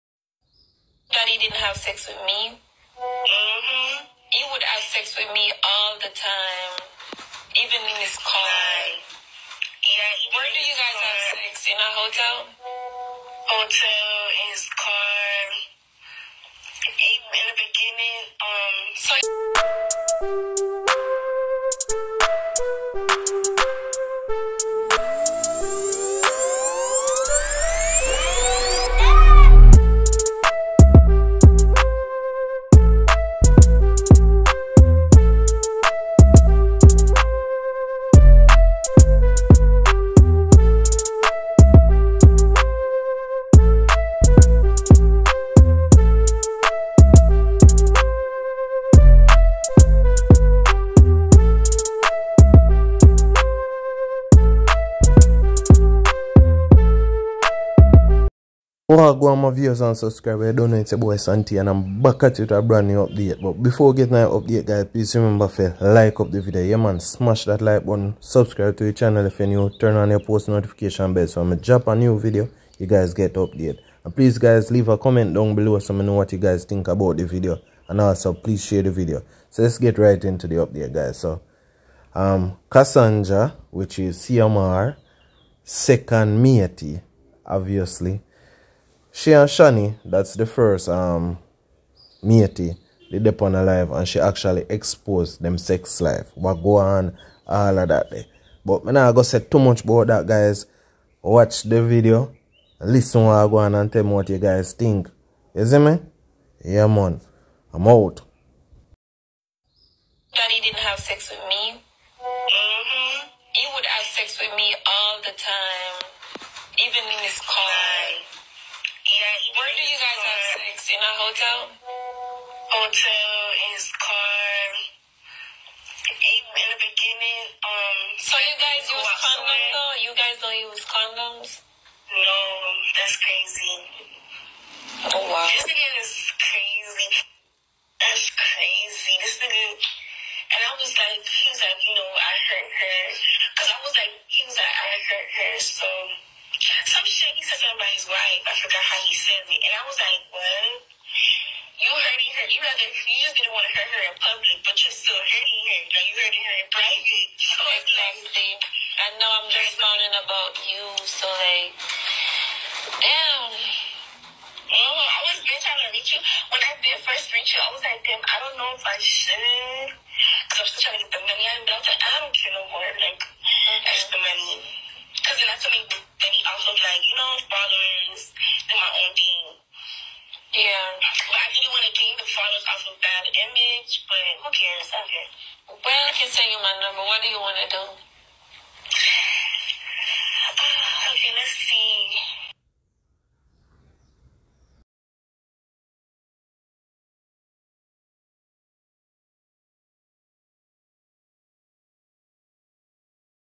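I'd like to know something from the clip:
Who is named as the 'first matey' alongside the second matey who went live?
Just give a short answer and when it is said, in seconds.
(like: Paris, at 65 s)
Shani, at 89 s.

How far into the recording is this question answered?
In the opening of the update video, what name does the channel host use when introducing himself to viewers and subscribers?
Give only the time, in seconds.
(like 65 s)
61 s.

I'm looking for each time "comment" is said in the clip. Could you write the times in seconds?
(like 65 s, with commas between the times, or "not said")
74 s.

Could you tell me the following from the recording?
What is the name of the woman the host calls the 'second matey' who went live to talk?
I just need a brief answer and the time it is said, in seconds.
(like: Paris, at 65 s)
Cassandra, at 82 s.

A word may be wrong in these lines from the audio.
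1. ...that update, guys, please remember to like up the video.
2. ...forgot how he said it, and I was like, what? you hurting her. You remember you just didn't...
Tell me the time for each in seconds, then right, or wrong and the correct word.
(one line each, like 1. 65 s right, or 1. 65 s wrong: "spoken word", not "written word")
1. 64 s right
2. 148 s wrong: "rather", not "remember".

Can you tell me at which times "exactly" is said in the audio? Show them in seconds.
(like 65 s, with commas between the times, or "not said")
157 s.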